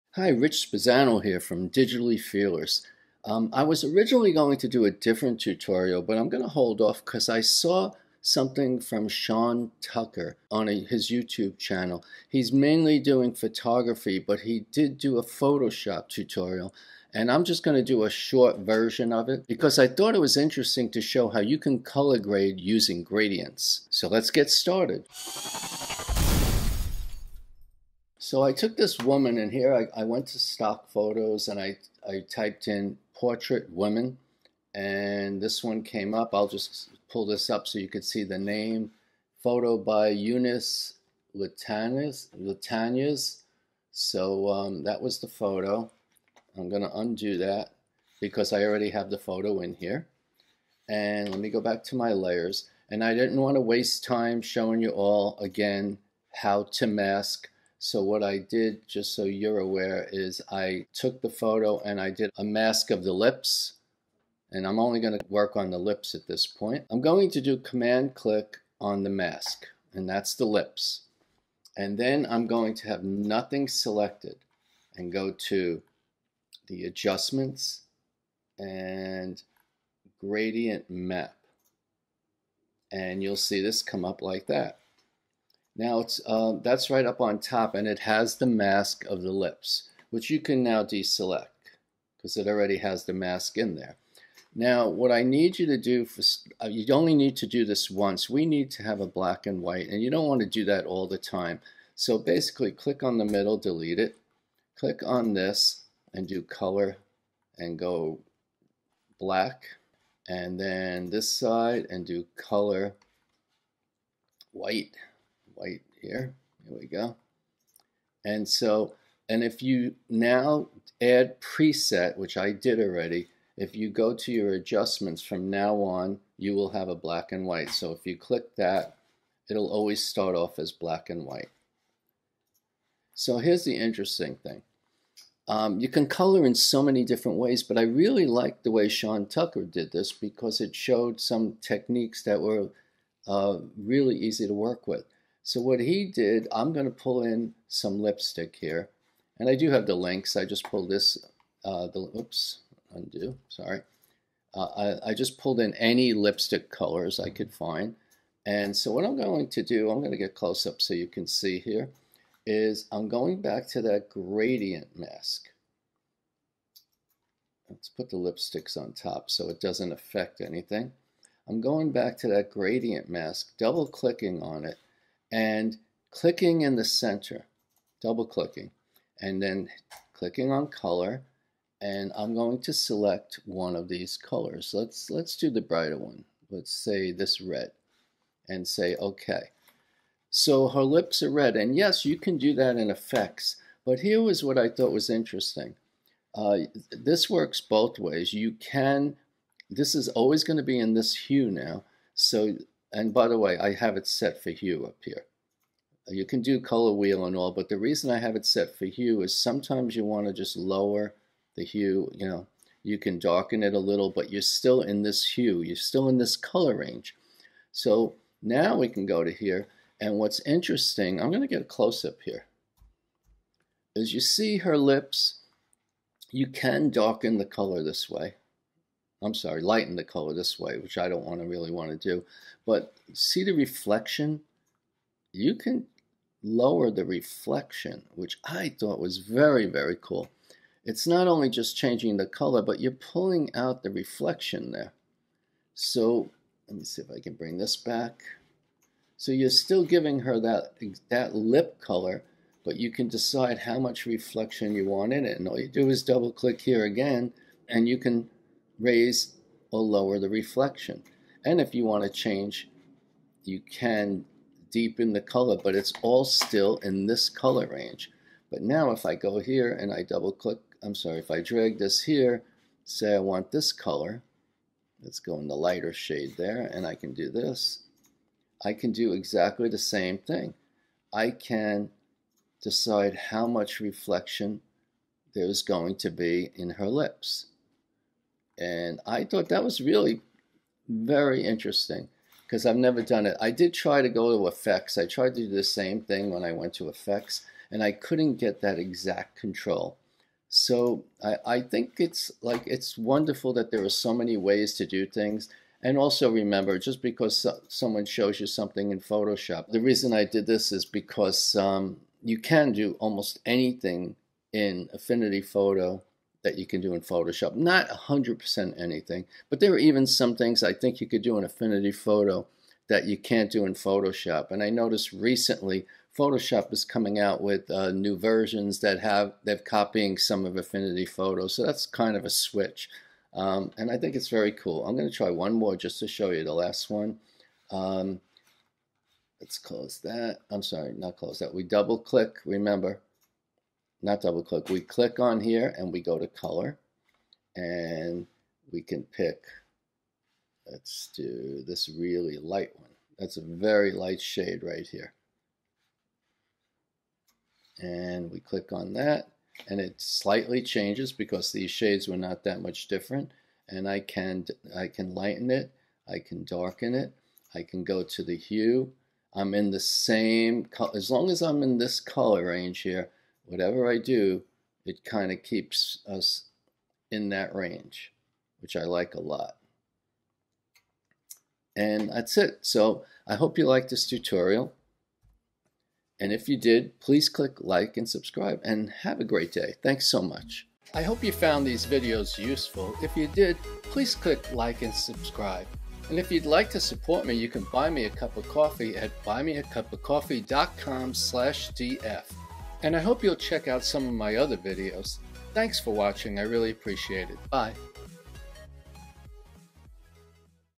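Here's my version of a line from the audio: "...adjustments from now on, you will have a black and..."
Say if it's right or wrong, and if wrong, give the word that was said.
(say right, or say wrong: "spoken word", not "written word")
right.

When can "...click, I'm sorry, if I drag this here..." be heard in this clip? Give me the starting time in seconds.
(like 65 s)
270 s.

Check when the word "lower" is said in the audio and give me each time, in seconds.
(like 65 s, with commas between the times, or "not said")
210 s, 236 s, 259 s.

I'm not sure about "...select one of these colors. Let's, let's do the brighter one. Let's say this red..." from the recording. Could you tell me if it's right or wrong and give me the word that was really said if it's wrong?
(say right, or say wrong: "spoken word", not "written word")
right.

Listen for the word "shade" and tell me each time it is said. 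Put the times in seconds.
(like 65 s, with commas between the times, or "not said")
275 s, 354 s, 361 s.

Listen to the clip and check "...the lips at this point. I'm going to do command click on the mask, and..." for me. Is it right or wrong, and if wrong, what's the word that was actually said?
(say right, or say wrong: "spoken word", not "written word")
right.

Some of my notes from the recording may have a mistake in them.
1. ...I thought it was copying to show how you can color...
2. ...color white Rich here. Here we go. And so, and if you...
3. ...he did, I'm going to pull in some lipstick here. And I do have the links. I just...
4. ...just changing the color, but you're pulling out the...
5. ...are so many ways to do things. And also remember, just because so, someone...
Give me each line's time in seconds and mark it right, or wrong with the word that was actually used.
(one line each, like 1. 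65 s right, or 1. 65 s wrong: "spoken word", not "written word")
1. 19 s wrong: "interesting", not "copying"
2. 112 s wrong: "White", not "Rich"
3. 145 s right
4. 241 s right
5. 303 s right.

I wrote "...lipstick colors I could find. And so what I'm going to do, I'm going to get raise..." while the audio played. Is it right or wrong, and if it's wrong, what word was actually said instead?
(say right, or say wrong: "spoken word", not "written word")
wrong: "close", not "raise".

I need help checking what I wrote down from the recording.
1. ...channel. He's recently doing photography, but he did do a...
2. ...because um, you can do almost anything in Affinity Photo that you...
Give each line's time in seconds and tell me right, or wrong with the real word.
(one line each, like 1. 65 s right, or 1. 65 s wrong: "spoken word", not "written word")
1. 11 s wrong: "mainly", not "recently"
2. 310 s right.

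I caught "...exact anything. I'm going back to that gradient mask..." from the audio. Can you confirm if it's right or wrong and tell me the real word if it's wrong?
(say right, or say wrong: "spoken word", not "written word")
wrong: "affect", not "exact".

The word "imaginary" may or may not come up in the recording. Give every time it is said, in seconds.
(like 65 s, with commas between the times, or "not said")
not said.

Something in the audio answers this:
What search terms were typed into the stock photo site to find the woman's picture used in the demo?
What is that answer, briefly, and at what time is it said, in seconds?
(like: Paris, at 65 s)
portrait women, at 33 s.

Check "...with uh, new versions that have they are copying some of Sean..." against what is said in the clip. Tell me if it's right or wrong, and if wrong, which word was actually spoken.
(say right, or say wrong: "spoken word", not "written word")
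wrong: "Affinity", not "Sean".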